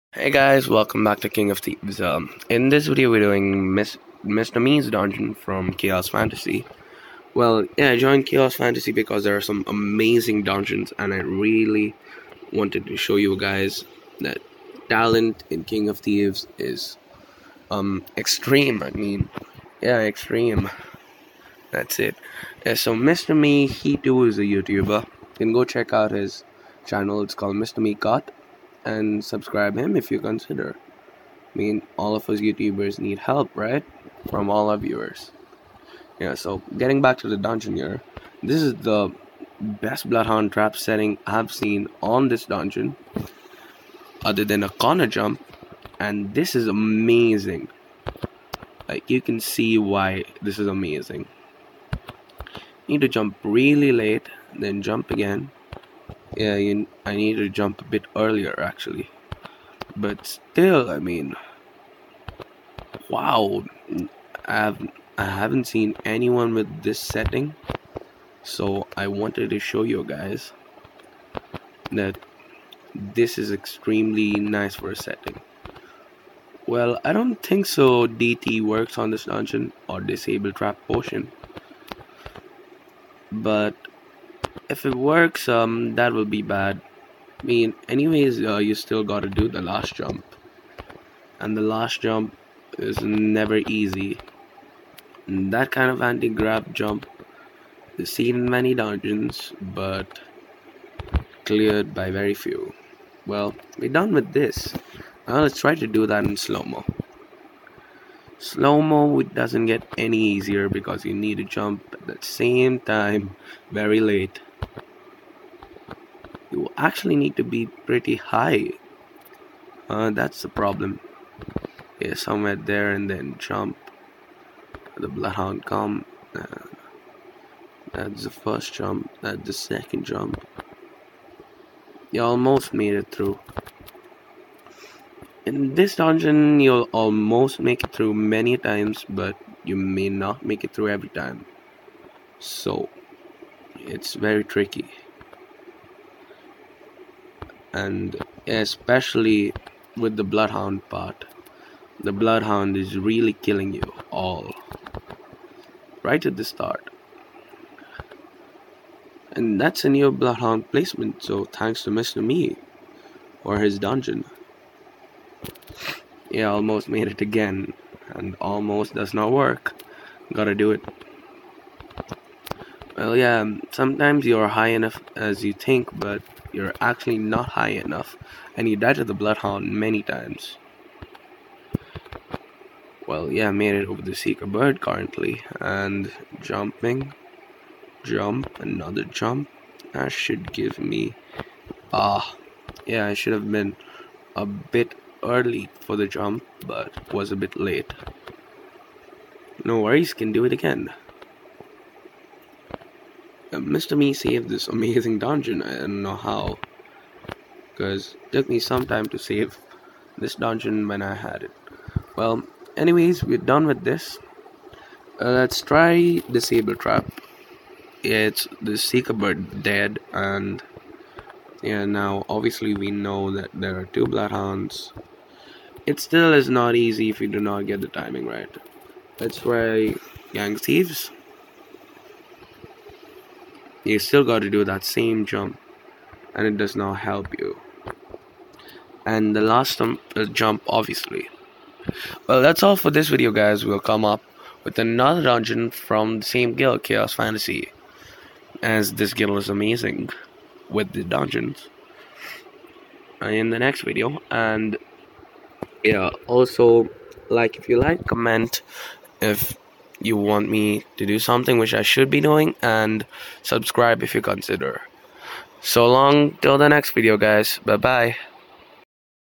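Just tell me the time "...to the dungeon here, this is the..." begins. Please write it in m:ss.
0:37.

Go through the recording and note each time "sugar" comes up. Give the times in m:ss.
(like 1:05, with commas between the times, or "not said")
not said.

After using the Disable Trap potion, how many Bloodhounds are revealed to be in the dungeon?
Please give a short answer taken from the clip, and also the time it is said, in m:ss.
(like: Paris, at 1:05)
2, at 3:43.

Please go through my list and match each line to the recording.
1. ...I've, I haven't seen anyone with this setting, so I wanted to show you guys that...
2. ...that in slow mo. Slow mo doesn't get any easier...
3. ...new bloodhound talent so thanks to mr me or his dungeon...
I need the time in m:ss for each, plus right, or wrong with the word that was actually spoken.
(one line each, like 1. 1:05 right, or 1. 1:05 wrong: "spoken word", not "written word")
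1. 1:04 right
2. 1:46 right
3. 2:39 wrong: "placement", not "talent".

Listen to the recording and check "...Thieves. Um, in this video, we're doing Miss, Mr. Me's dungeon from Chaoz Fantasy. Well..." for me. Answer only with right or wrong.
right.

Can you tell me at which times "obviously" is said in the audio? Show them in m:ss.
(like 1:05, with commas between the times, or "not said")
3:42, 4:00.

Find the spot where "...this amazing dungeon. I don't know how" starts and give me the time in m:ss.
3:24.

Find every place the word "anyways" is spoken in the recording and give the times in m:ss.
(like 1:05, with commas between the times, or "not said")
1:27, 3:32.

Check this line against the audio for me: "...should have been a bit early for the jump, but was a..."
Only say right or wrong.
right.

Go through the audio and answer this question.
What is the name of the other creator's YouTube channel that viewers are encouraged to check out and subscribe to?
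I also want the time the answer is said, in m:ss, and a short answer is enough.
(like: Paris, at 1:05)
Mr. Me KOT, at 0:27.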